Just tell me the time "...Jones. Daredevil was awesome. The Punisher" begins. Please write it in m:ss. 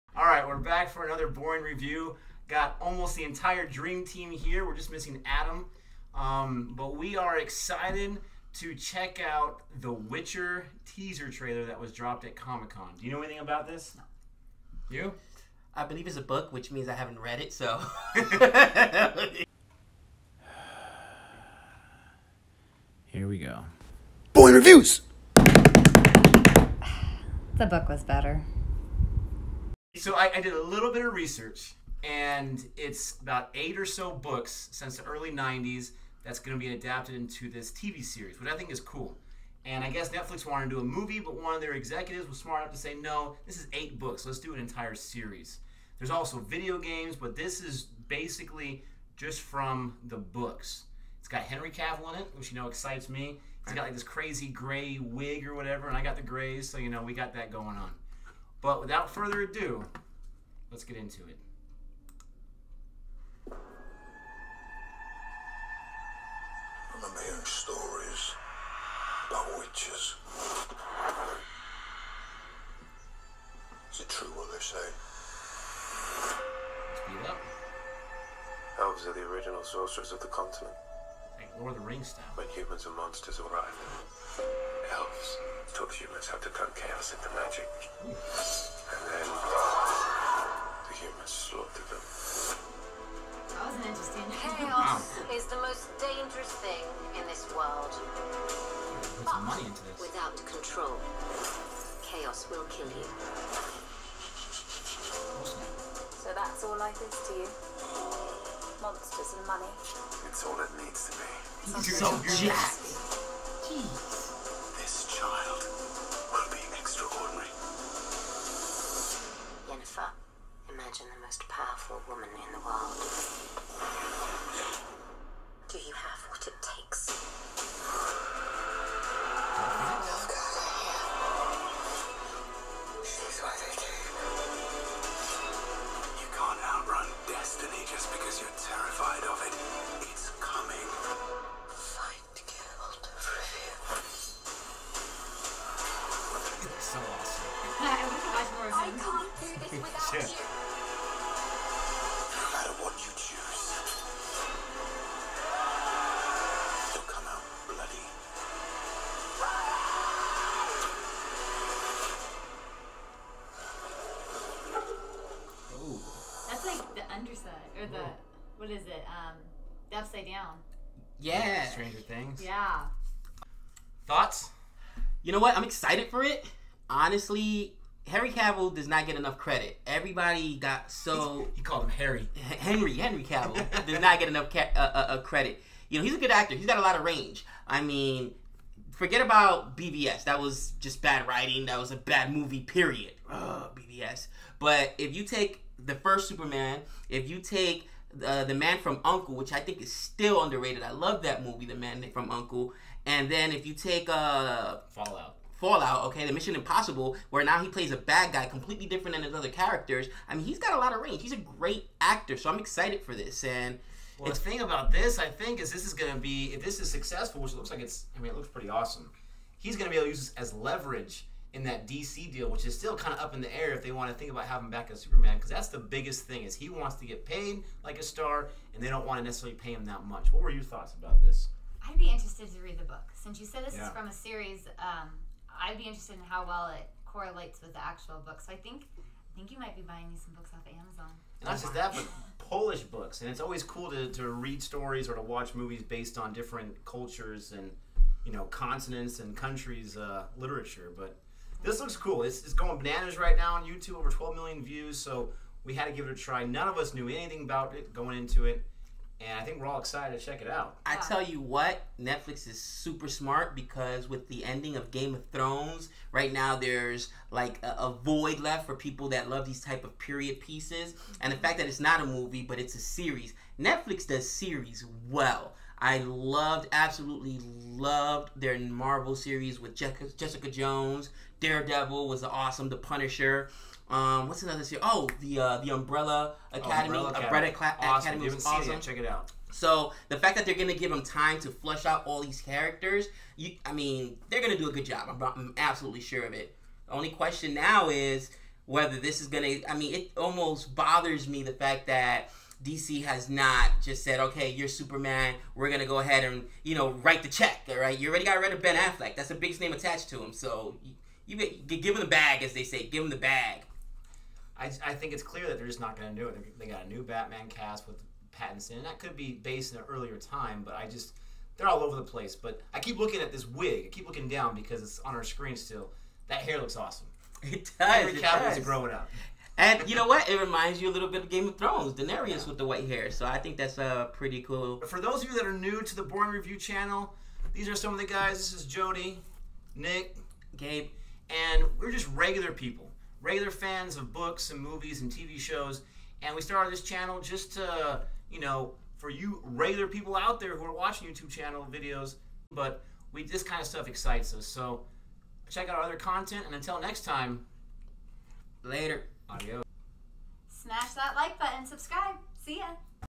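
4:40.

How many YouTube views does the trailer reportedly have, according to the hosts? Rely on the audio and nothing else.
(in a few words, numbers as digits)
12 million.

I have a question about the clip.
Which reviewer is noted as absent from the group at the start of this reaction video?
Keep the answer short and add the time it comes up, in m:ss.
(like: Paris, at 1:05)
Adam, at 0:05.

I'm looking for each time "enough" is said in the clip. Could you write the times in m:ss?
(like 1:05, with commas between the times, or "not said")
0:42, 2:59, 3:04.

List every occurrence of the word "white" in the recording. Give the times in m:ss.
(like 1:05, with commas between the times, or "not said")
5:32.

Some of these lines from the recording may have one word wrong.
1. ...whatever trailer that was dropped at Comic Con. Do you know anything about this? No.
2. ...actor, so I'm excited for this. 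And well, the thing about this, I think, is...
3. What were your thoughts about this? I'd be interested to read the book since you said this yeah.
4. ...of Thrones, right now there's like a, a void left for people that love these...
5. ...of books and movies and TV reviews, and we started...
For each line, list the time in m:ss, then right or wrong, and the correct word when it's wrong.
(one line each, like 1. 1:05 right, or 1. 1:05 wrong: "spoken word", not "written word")
1. 0:10 wrong: "teaser", not "whatever"
2. 3:32 right
3. 3:50 right
4. 4:25 right
5. 5:43 wrong: "shows", not "reviews".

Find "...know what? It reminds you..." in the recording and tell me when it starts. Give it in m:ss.
5:29.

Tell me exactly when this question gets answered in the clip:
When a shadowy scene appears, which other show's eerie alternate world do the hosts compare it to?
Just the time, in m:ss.
2:51.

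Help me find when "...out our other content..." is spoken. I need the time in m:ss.
5:55.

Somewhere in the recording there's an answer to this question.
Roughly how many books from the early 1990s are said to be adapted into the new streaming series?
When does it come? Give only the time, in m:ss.
0:33.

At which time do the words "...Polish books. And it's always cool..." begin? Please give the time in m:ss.
4:02.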